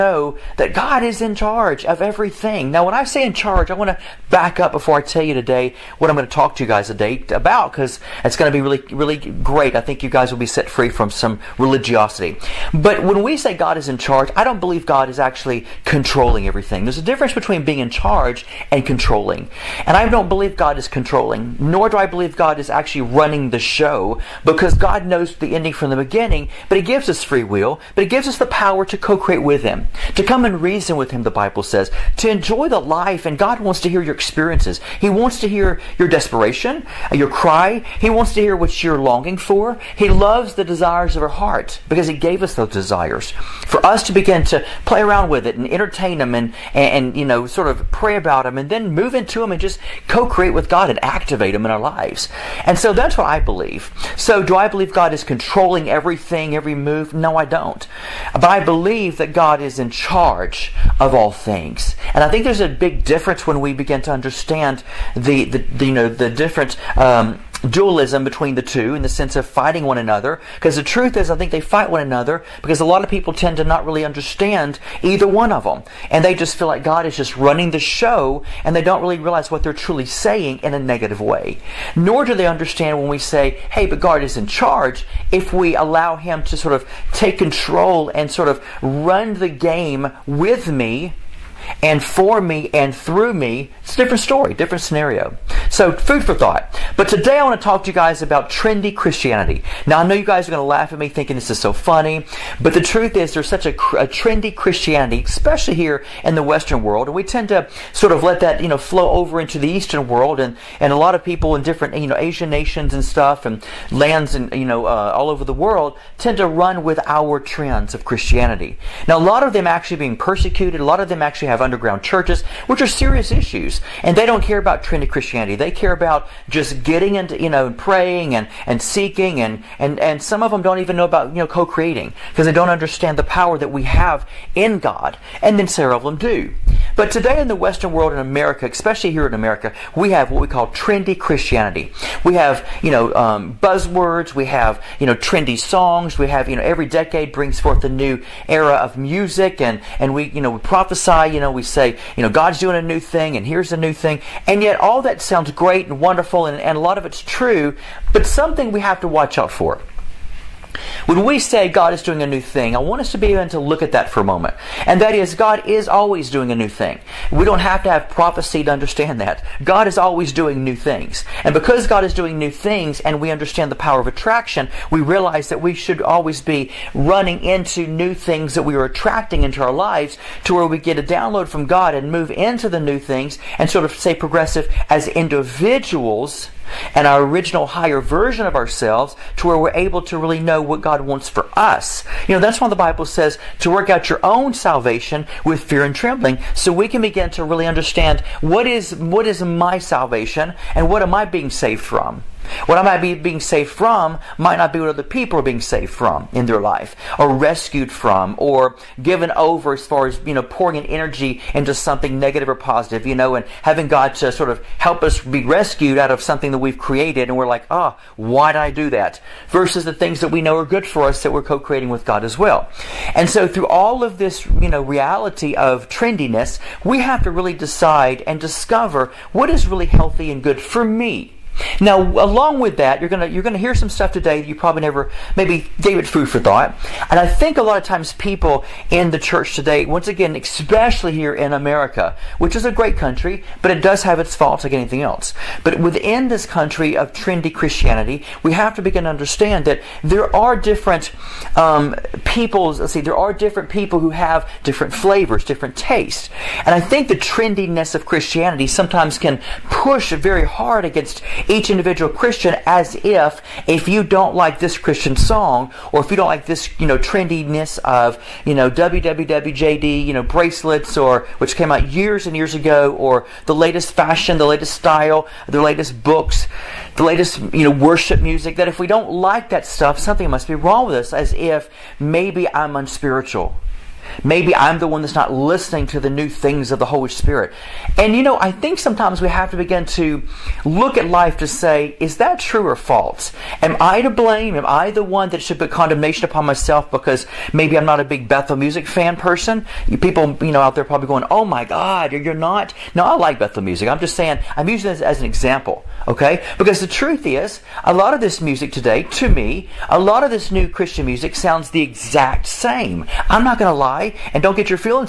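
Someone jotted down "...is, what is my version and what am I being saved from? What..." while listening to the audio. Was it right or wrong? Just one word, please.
wrong.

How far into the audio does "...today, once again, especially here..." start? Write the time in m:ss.
3:59.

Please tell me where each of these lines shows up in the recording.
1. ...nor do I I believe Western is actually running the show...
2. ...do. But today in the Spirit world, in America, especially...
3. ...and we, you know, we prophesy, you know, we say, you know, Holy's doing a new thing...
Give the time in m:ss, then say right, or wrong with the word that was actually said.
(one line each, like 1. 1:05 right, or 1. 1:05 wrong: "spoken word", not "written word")
1. 0:21 wrong: "God", not "Western"
2. 2:16 wrong: "Western", not "Spirit"
3. 2:29 wrong: "God", not "Holy".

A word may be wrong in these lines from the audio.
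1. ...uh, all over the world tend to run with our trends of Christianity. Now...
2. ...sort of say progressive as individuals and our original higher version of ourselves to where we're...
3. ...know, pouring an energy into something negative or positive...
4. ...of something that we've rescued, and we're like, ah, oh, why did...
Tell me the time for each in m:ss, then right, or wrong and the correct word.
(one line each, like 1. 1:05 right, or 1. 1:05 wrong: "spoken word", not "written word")
1. 1:54 right
2. 3:03 right
3. 3:30 right
4. 3:36 wrong: "created", not "rescued".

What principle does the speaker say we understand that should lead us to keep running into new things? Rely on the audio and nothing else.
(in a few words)
Power of attraction.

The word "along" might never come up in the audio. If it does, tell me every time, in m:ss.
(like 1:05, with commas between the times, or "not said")
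3:52.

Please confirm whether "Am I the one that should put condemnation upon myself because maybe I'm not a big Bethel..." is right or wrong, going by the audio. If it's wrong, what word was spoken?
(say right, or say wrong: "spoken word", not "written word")
right.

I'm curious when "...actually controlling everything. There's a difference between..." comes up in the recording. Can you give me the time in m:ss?
0:15.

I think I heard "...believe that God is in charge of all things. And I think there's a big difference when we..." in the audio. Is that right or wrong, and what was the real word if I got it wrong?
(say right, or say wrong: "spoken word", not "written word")
right.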